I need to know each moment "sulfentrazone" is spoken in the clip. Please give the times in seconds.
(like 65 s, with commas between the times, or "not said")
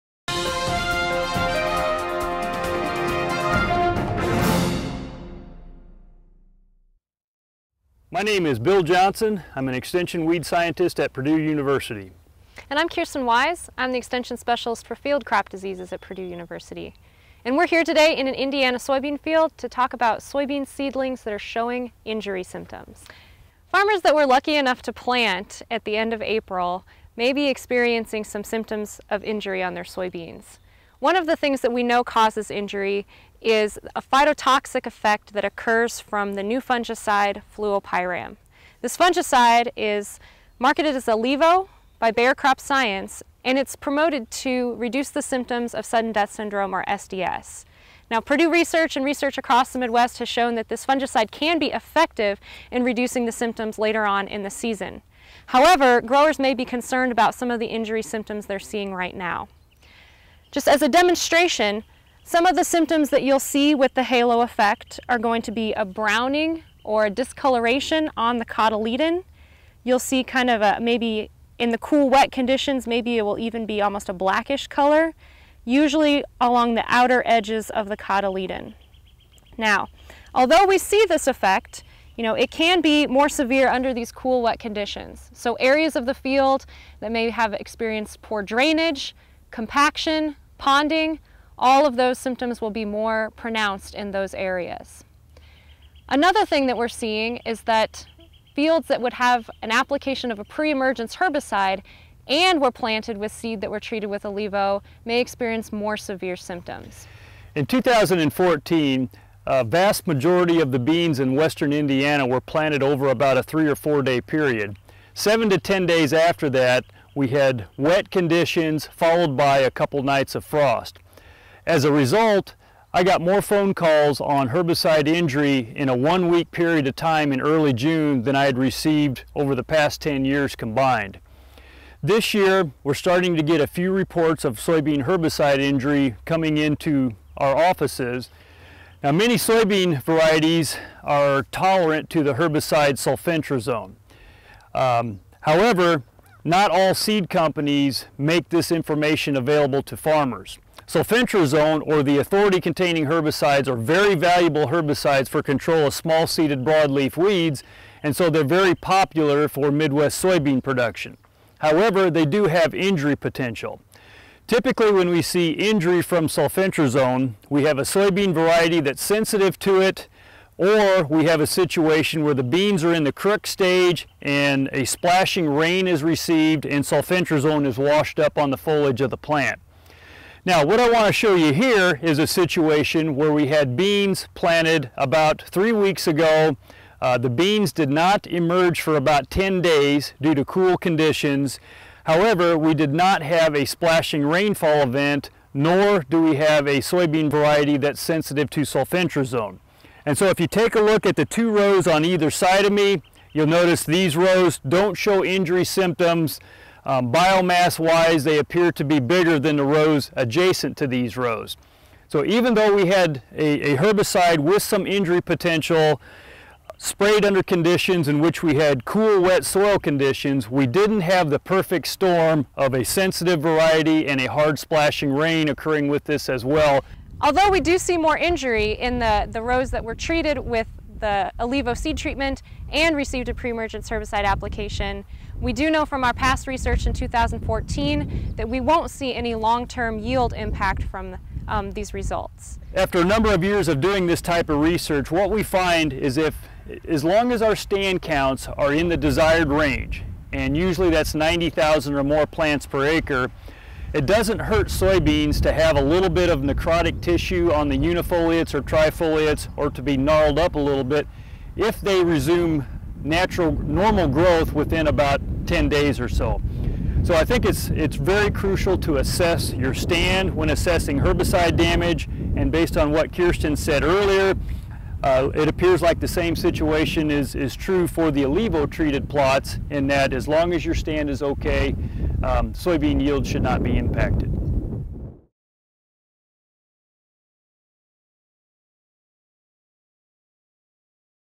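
142 s, 150 s, 166 s, 176 s, 198 s.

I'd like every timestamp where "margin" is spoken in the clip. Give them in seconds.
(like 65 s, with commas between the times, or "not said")
not said.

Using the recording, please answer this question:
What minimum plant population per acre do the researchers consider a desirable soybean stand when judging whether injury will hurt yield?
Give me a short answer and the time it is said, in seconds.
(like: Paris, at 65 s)
90,000, at 251 s.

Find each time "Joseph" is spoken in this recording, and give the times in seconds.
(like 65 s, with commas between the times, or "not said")
not said.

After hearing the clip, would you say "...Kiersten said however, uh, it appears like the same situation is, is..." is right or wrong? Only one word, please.
wrong.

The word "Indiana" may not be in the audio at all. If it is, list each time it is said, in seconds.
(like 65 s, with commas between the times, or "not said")
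18 s, 111 s.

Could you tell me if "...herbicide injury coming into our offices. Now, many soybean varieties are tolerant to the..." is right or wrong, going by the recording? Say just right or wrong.
right.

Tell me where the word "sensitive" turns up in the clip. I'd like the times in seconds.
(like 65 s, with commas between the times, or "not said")
169 s, 198 s, 222 s.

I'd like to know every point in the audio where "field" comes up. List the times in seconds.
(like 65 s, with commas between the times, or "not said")
14 s, 19 s, 86 s, 98 s.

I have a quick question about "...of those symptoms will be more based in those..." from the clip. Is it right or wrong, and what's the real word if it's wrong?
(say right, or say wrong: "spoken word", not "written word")
wrong: "pronounced", not "based".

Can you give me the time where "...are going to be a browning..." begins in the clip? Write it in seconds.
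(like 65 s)
65 s.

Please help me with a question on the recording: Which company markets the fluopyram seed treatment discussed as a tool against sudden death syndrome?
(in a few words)
Bayer Crop Science.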